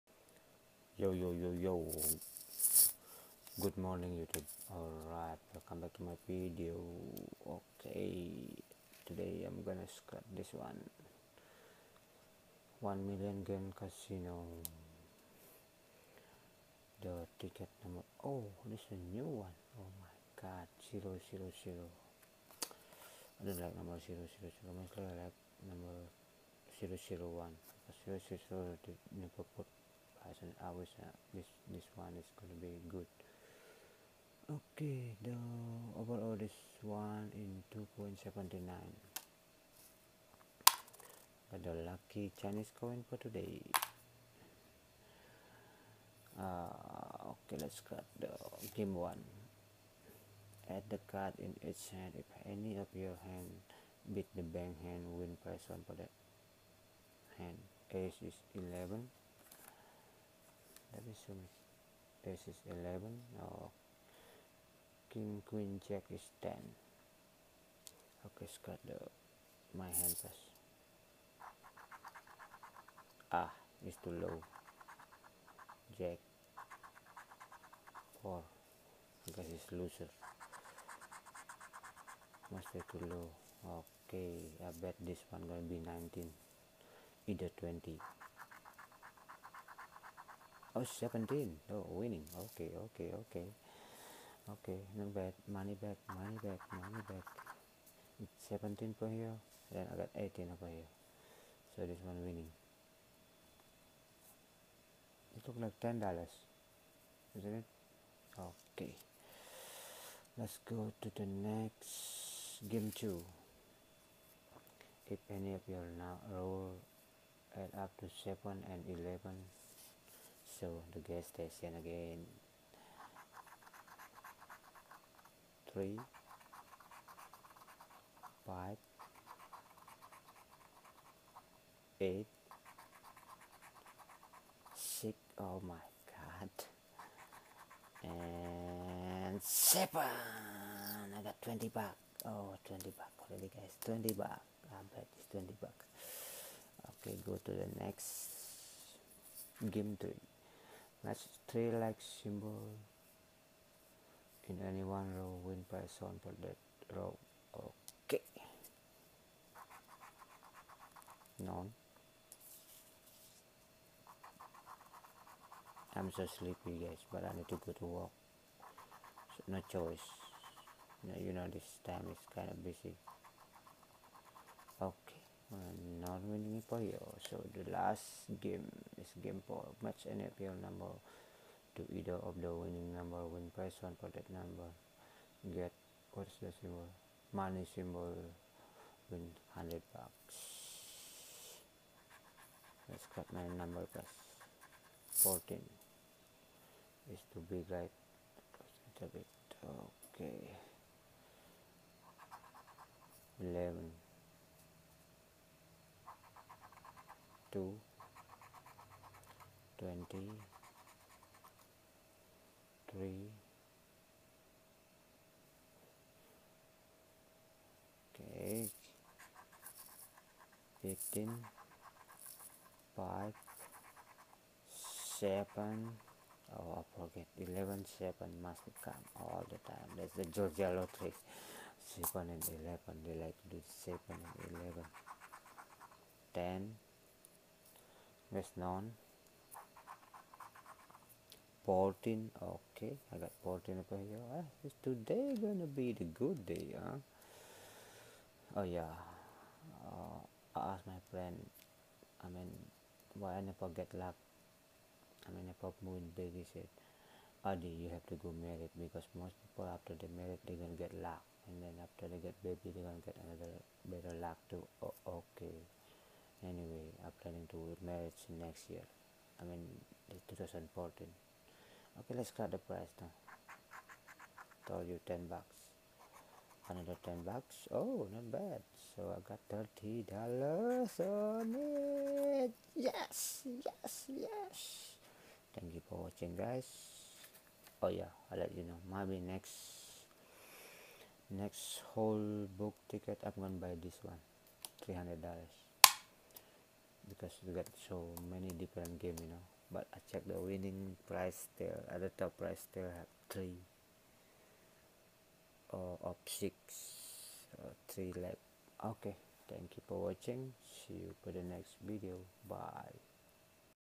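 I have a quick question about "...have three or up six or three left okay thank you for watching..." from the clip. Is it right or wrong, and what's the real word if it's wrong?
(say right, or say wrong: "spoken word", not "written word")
right.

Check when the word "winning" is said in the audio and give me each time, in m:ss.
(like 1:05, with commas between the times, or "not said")
1:31, 1:42, 2:56, 3:02, 5:00.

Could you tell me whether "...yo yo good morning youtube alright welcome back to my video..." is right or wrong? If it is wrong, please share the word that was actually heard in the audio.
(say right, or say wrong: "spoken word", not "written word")
right.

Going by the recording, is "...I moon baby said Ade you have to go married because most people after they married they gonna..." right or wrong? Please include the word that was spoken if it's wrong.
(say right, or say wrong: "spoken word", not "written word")
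right.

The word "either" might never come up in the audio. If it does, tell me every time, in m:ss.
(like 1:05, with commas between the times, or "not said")
1:27, 3:01.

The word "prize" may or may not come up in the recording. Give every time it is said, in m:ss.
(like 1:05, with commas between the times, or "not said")
3:03.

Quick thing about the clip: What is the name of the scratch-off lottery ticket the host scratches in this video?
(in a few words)
1 Million Game Casino.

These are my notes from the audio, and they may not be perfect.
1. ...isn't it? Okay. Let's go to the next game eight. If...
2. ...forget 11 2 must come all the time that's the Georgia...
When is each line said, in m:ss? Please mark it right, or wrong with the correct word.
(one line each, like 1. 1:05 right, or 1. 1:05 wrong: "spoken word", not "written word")
1. 1:47 wrong: "two", not "eight"
2. 3:46 wrong: "7", not "2".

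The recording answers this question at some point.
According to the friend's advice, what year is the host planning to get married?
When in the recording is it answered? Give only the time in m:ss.
4:30.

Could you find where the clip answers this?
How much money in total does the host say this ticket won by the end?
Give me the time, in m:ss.
4:39.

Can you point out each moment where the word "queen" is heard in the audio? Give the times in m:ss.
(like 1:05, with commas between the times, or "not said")
1:05.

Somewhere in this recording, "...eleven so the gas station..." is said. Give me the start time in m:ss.
1:58.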